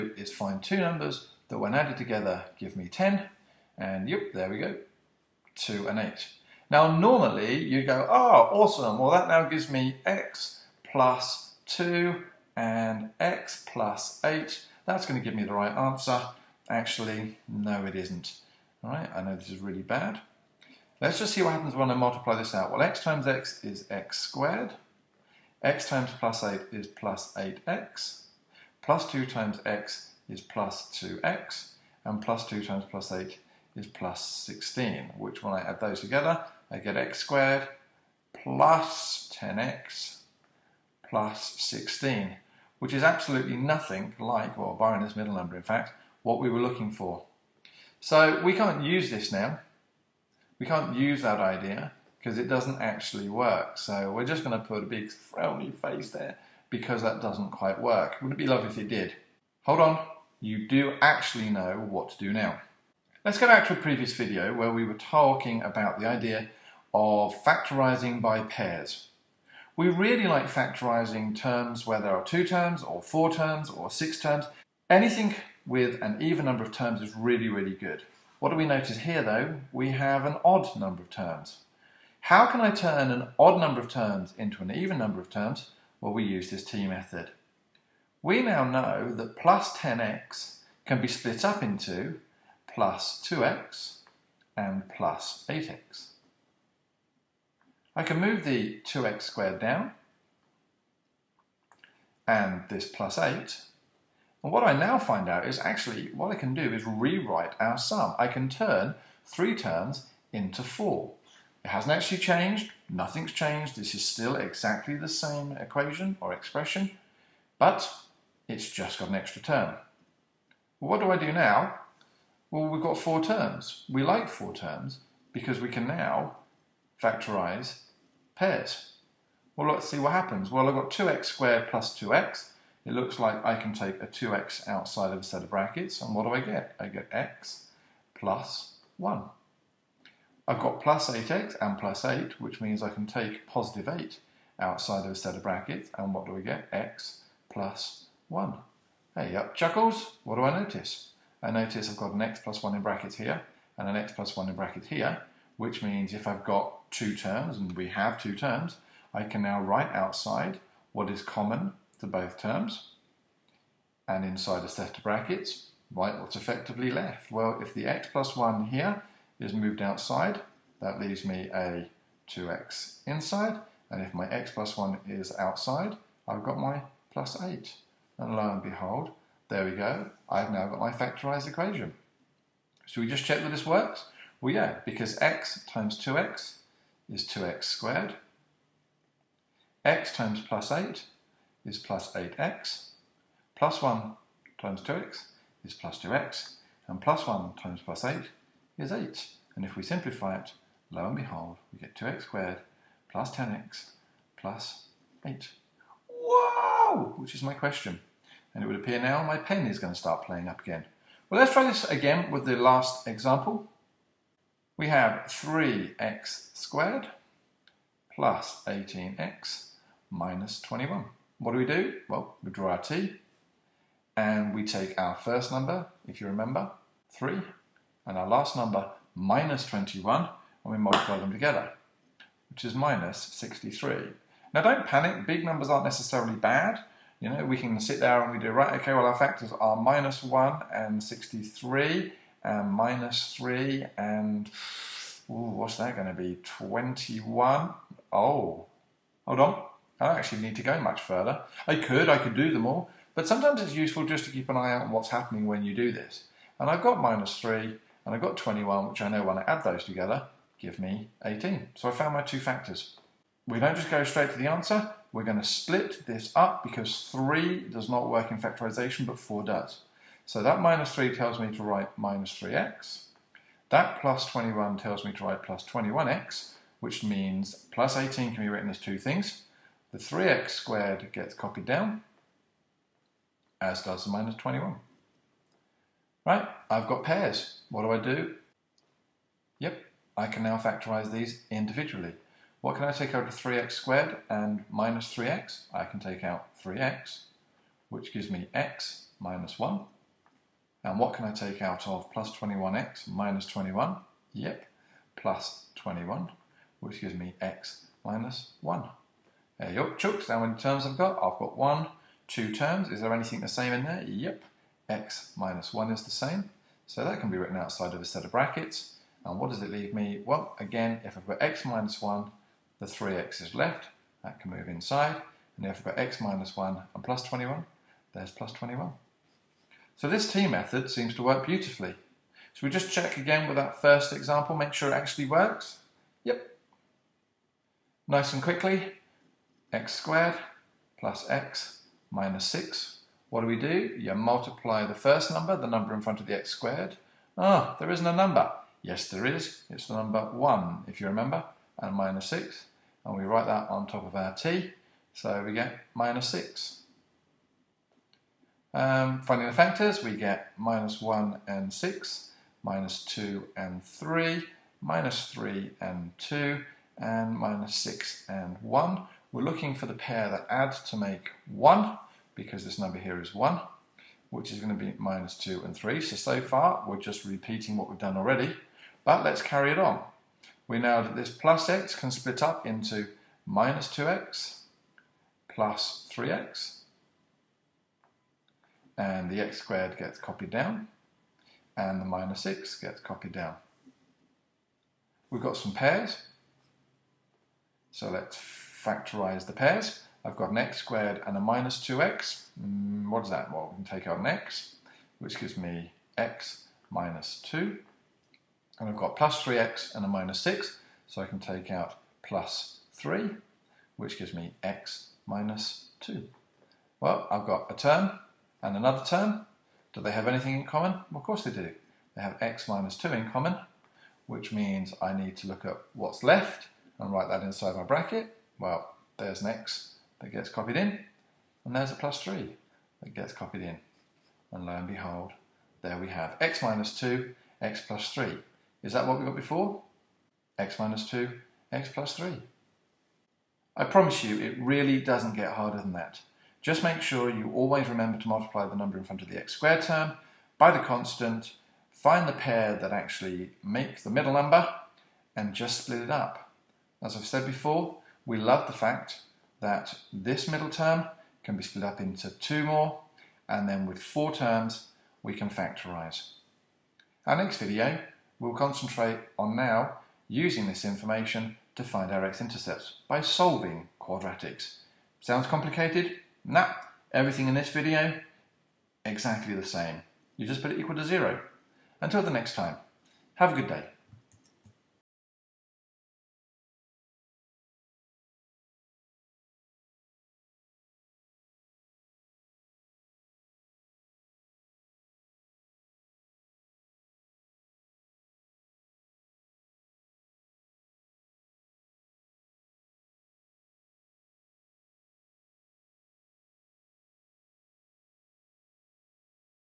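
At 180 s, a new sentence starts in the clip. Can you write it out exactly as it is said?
I've now got my factorized equation.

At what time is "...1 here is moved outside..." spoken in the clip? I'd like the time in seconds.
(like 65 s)
168 s.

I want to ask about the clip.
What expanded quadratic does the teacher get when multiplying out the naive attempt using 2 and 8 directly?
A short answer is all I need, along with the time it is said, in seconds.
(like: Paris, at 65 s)
x squared plus 10x plus 16, at 36 s.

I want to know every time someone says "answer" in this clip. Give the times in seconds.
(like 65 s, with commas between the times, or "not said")
15 s, 264 s.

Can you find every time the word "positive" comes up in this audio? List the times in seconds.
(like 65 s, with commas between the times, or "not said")
143 s.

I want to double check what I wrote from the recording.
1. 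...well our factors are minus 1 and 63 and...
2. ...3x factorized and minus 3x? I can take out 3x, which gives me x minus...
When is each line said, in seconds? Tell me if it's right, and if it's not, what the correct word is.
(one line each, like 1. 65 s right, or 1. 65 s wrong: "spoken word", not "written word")
1. 238 s right
2. 293 s wrong: "squared", not "factorized".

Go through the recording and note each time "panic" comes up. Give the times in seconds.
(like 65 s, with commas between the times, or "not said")
234 s.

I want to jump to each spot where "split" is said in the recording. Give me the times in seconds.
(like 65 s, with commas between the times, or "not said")
91 s, 265 s, 382 s, 455 s, 461 s.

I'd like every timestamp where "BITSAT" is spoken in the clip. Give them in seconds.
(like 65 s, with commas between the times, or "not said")
not said.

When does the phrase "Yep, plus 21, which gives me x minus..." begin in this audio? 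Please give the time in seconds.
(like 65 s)
304 s.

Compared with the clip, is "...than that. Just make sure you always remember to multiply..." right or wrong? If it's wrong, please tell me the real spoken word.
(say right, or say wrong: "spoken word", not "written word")
right.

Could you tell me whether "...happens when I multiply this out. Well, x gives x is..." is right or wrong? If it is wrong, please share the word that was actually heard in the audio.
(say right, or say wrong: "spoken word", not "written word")
wrong: "times", not "gives".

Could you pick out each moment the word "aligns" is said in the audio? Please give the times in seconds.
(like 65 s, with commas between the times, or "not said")
not said.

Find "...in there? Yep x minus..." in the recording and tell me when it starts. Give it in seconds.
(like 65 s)
313 s.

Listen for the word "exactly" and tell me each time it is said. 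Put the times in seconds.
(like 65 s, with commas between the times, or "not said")
114 s, 479 s.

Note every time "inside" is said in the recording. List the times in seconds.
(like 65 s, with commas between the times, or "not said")
164 s, 173 s, 324 s, 427 s.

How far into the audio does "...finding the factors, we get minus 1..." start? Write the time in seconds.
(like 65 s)
359 s.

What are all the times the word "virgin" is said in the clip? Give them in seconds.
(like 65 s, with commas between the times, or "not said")
not said.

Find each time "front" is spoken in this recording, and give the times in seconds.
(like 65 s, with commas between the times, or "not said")
346 s, 449 s.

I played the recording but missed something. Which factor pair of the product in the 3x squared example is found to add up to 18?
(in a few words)
-3 and 21.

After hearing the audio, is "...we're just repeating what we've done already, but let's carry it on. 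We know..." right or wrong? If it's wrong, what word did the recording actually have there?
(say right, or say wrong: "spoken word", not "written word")
right.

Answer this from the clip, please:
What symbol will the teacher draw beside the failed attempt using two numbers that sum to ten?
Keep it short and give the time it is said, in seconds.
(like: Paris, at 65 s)
a big frowny face, at 54 s.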